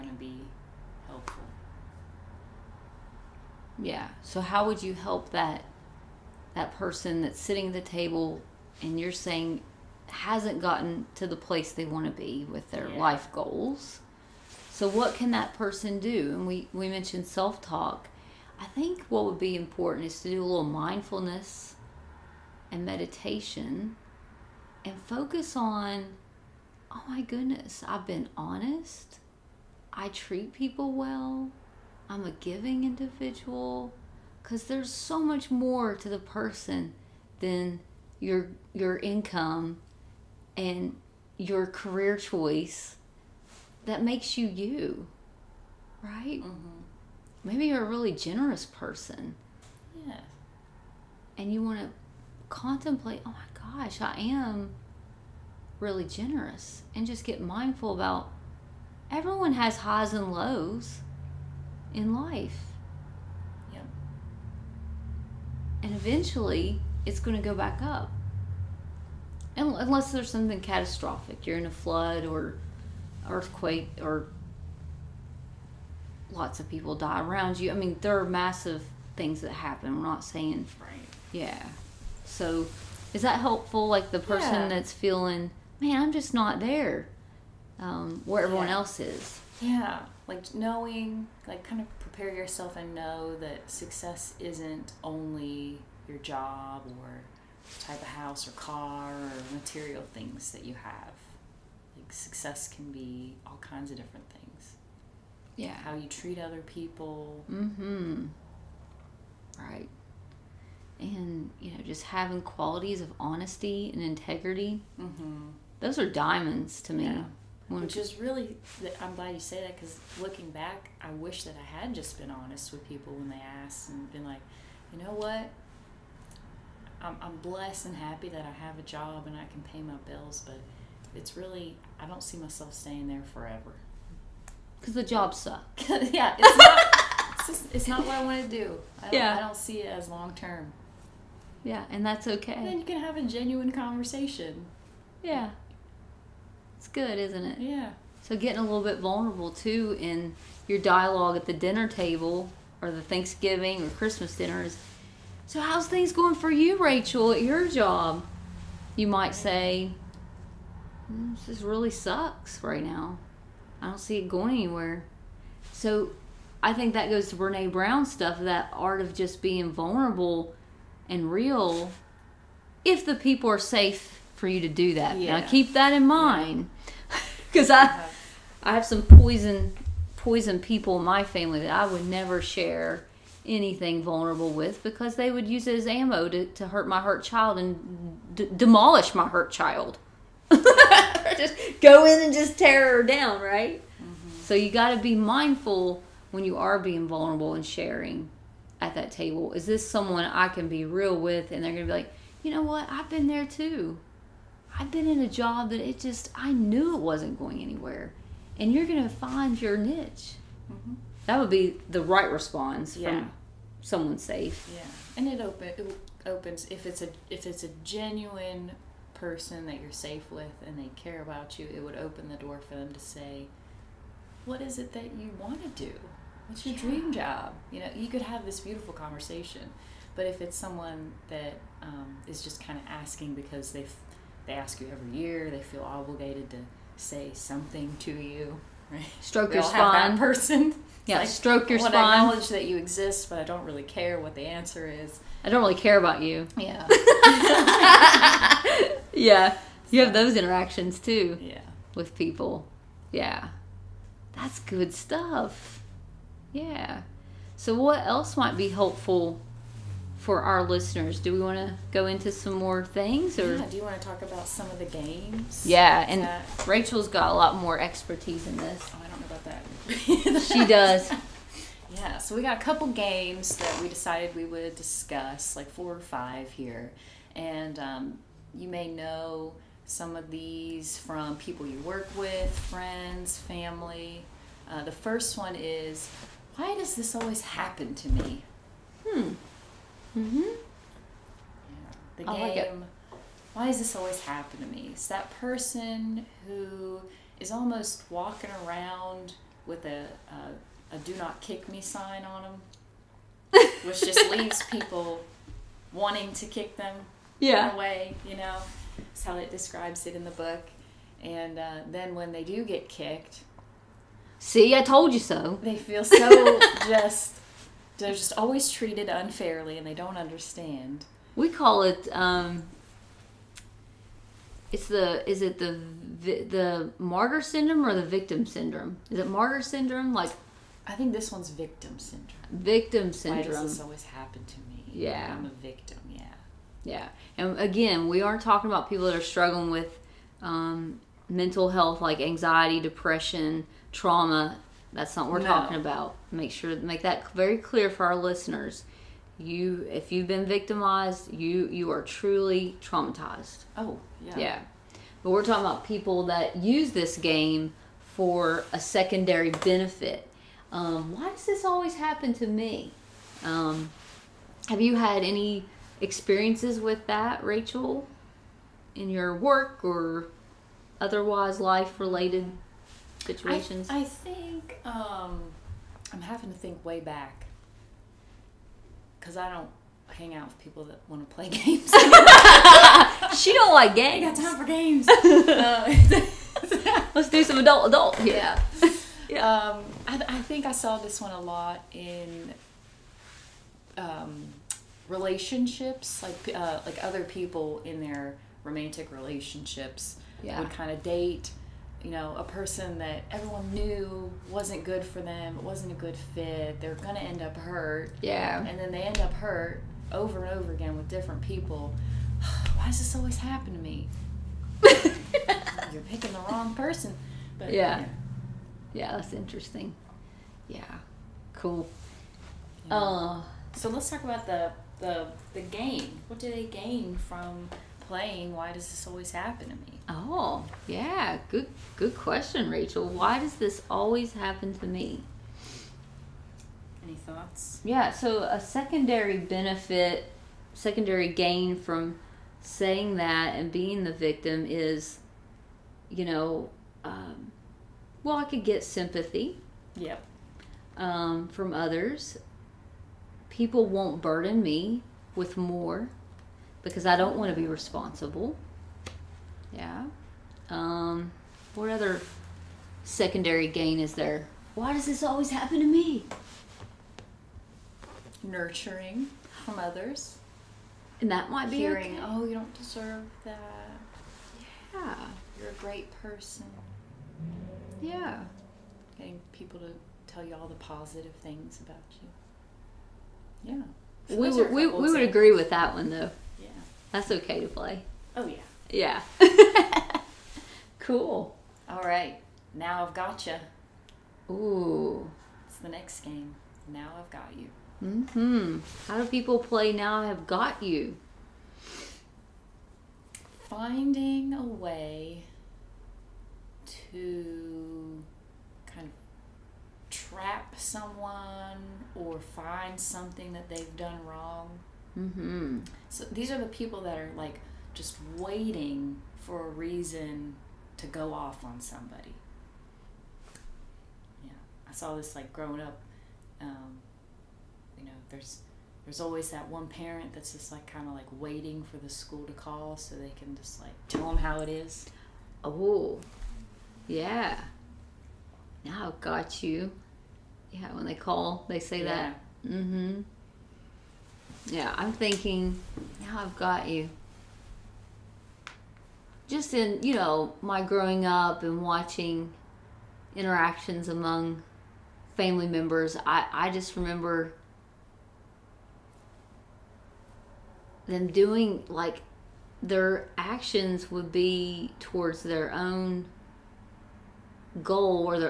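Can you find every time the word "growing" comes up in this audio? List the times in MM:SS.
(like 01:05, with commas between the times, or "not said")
08:45, 09:10.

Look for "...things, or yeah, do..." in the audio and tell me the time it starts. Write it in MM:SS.
04:22.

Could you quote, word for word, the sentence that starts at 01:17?
I mean, there are massive things that happen.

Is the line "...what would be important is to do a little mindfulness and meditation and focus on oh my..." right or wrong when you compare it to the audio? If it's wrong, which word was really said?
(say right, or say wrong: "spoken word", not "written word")
right.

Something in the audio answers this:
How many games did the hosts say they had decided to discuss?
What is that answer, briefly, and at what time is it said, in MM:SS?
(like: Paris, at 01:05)
Four or five, at 04:35.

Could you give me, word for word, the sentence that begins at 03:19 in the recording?
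Is this someone I can be real with?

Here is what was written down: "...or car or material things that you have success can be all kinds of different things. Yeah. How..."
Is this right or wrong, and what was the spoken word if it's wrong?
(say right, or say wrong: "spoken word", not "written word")
right.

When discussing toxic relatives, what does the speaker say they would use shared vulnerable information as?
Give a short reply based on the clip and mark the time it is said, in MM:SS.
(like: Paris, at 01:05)
Ammo, at 03:05.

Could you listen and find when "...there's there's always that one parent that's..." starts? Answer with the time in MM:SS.
08:48.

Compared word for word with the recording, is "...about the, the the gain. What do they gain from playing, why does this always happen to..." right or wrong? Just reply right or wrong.
right.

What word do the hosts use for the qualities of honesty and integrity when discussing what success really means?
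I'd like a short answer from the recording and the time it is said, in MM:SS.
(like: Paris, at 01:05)
Diamonds, at 01:56.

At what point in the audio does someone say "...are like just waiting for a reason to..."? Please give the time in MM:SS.
08:37.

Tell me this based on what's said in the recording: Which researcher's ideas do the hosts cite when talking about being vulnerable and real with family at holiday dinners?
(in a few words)
Brene Brown.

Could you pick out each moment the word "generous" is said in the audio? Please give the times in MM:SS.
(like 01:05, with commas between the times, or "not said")
00:48, 00:56.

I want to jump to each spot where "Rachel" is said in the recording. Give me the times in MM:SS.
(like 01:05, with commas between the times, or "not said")
02:36, 04:26, 06:07, 07:12.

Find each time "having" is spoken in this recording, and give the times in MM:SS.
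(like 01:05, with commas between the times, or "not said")
01:52, 06:16.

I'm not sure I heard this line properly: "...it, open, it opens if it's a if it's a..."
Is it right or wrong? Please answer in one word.
right.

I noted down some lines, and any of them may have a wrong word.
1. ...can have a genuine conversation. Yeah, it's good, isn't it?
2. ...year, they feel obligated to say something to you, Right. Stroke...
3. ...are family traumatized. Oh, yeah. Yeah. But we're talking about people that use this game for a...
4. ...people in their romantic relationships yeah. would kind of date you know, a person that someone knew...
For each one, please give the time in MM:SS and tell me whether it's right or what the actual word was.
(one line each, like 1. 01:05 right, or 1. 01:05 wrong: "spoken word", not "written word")
1. 02:22 right
2. 03:55 right
3. 05:51 wrong: "truly", not "family"
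4. 06:37 wrong: "everyone", not "someone".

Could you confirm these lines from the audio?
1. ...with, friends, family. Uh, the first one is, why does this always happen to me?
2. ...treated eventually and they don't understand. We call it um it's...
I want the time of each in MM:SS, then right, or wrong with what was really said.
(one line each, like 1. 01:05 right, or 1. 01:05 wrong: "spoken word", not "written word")
1. 04:42 right
2. 05:18 wrong: "unfairly", not "eventually".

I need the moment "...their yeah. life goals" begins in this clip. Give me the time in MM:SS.
00:12.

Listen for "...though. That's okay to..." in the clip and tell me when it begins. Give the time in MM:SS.
08:06.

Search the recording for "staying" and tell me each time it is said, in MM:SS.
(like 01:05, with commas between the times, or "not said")
02:12.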